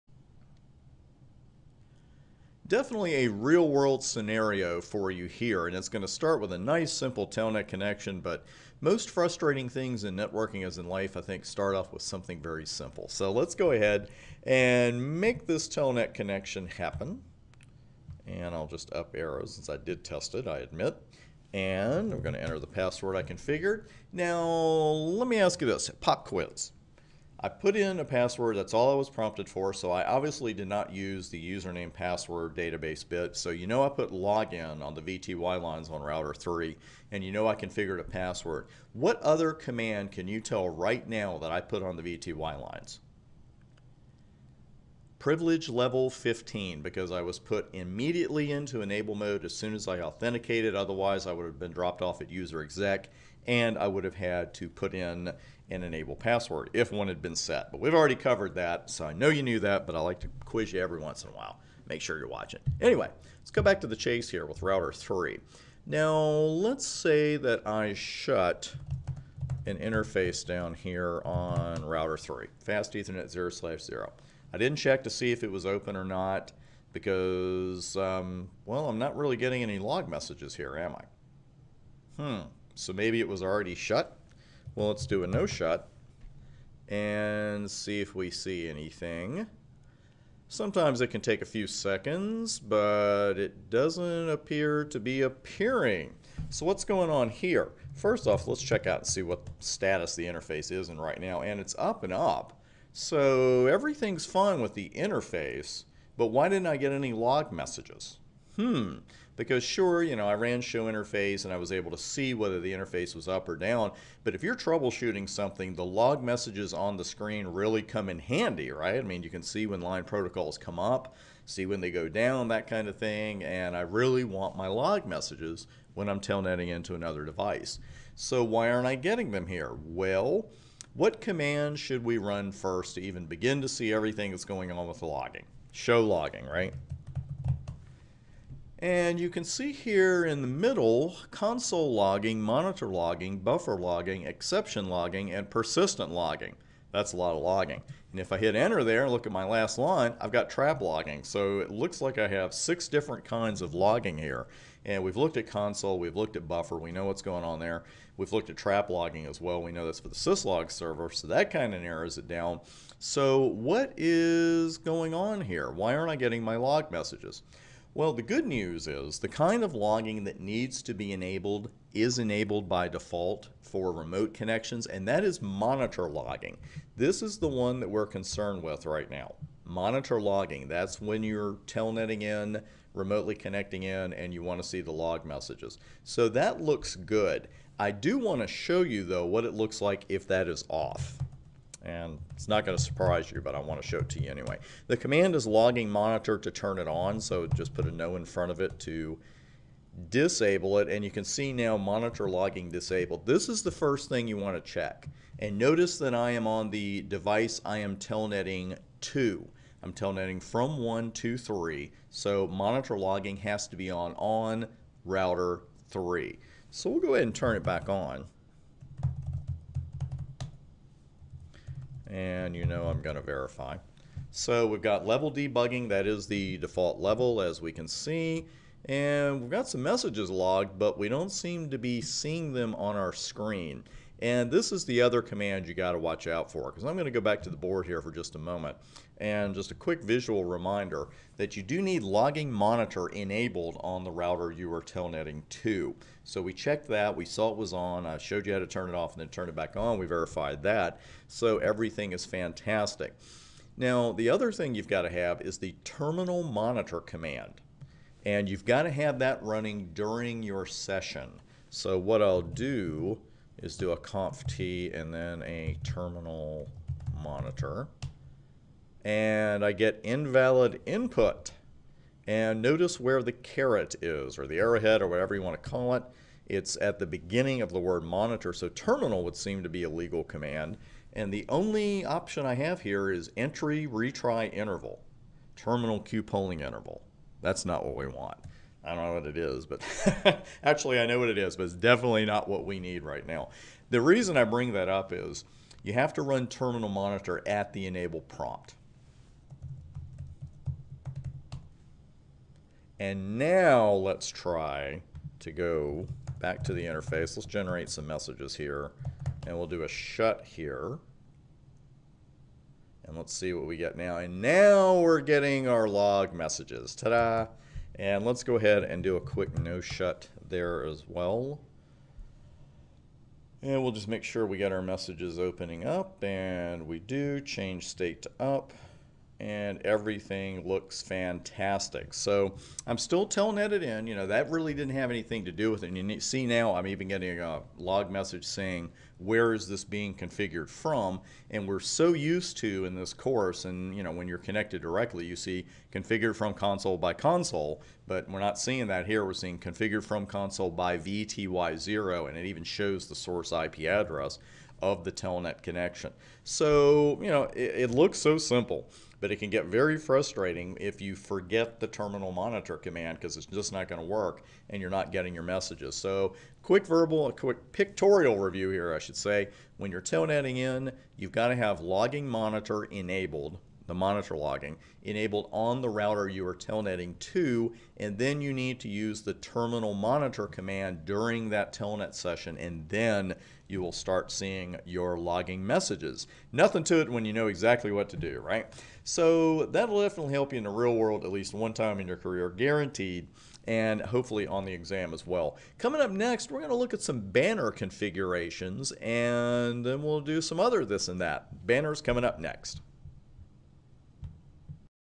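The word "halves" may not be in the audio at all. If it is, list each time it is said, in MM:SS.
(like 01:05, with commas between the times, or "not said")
not said.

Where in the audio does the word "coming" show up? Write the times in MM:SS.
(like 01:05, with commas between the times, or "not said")
06:35, 06:42.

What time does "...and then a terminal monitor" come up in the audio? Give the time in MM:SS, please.
04:24.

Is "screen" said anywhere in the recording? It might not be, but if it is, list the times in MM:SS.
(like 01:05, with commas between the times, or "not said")
01:57, 03:53.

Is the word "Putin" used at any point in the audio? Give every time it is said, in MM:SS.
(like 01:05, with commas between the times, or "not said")
not said.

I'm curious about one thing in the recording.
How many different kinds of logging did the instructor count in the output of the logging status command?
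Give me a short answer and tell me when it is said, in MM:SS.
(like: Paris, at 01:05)
6, at 02:32.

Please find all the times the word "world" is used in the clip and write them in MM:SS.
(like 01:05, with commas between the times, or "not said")
00:03, 06:30.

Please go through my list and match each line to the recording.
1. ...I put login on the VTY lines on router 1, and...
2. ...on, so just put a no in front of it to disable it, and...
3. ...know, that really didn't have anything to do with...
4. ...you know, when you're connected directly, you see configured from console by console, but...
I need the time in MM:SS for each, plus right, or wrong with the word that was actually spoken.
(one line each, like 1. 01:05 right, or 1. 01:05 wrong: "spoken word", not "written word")
1. 00:33 wrong: "3", not "1"
2. 03:16 right
3. 05:34 right
4. 05:43 right.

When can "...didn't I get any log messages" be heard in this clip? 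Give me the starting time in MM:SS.
01:46.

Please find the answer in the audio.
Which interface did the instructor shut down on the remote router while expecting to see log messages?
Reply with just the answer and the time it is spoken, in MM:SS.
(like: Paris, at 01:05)
fast ethernet 0/0, at 01:12.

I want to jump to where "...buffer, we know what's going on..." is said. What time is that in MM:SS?
02:36.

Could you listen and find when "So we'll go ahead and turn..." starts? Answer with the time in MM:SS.
03:36.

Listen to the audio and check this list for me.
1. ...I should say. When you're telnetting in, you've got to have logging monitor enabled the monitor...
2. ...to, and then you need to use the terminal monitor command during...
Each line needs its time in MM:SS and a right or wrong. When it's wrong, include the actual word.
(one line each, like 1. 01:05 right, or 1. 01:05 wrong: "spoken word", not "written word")
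1. 06:08 right
2. 06:17 right.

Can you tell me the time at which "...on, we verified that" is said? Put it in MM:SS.
04:09.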